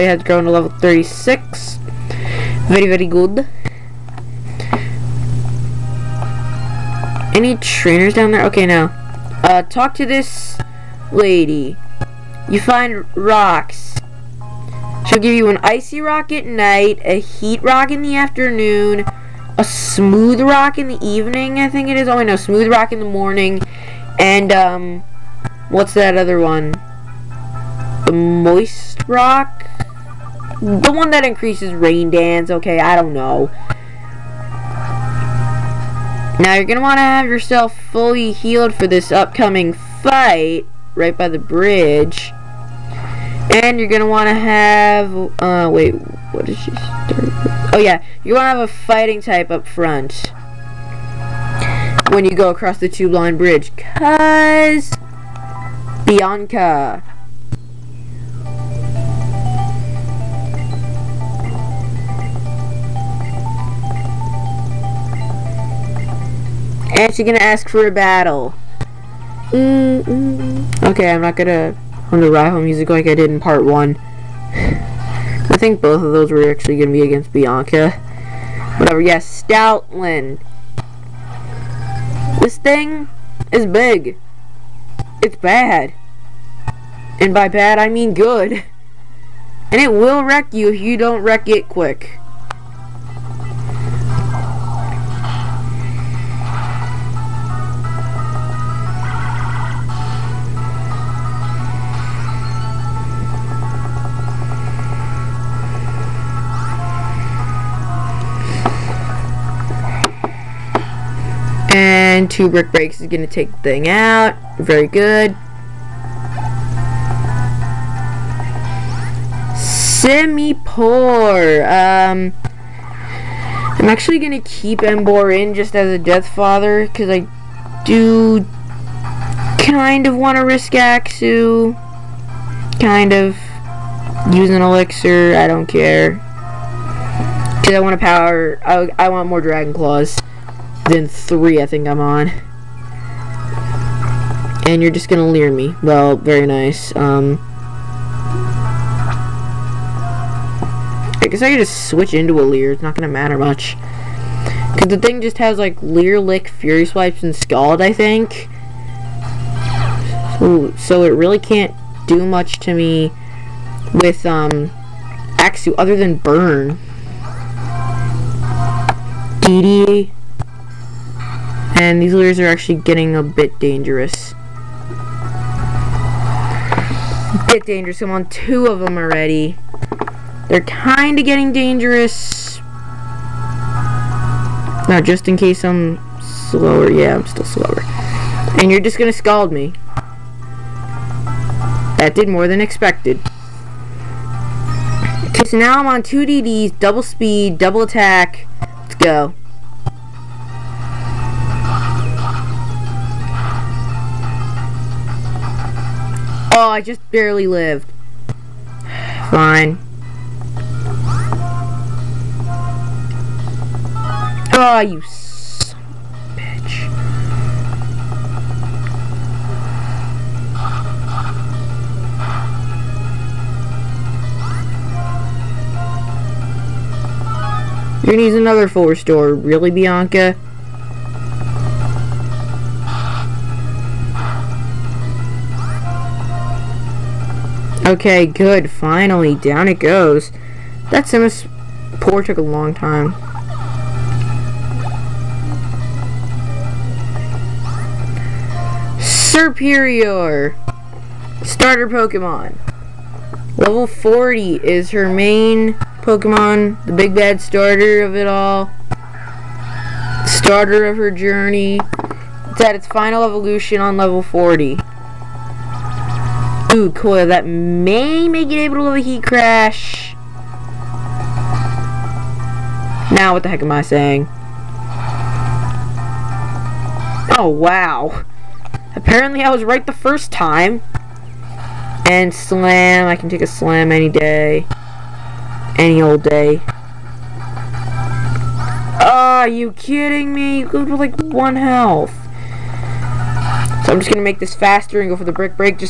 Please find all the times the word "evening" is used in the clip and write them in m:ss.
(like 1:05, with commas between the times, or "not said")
0:21.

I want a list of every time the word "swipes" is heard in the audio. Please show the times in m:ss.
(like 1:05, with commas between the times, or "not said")
2:36.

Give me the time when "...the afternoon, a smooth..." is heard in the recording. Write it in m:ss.
0:18.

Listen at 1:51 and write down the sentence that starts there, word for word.
And two brick breaks is going to take the thing out.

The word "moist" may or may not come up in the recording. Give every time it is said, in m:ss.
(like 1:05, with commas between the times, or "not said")
0:28.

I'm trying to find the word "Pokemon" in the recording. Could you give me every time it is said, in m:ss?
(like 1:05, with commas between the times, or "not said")
4:11, 4:16.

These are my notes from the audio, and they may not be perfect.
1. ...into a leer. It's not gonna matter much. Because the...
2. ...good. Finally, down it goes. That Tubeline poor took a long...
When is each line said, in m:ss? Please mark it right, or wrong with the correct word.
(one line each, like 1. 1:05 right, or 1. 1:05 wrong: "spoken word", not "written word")
1. 2:32 right
2. 3:58 wrong: "Sims", not "Tubeline".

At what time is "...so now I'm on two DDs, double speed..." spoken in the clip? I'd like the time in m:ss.
3:15.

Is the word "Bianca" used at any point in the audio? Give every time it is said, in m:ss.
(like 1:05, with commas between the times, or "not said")
0:56, 1:17, 3:49.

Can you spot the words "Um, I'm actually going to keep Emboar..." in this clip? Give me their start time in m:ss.
2:01.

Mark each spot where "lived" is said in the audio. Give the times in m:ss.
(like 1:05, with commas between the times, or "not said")
3:27.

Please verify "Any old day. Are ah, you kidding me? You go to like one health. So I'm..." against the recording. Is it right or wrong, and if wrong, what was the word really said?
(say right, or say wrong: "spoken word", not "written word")
right.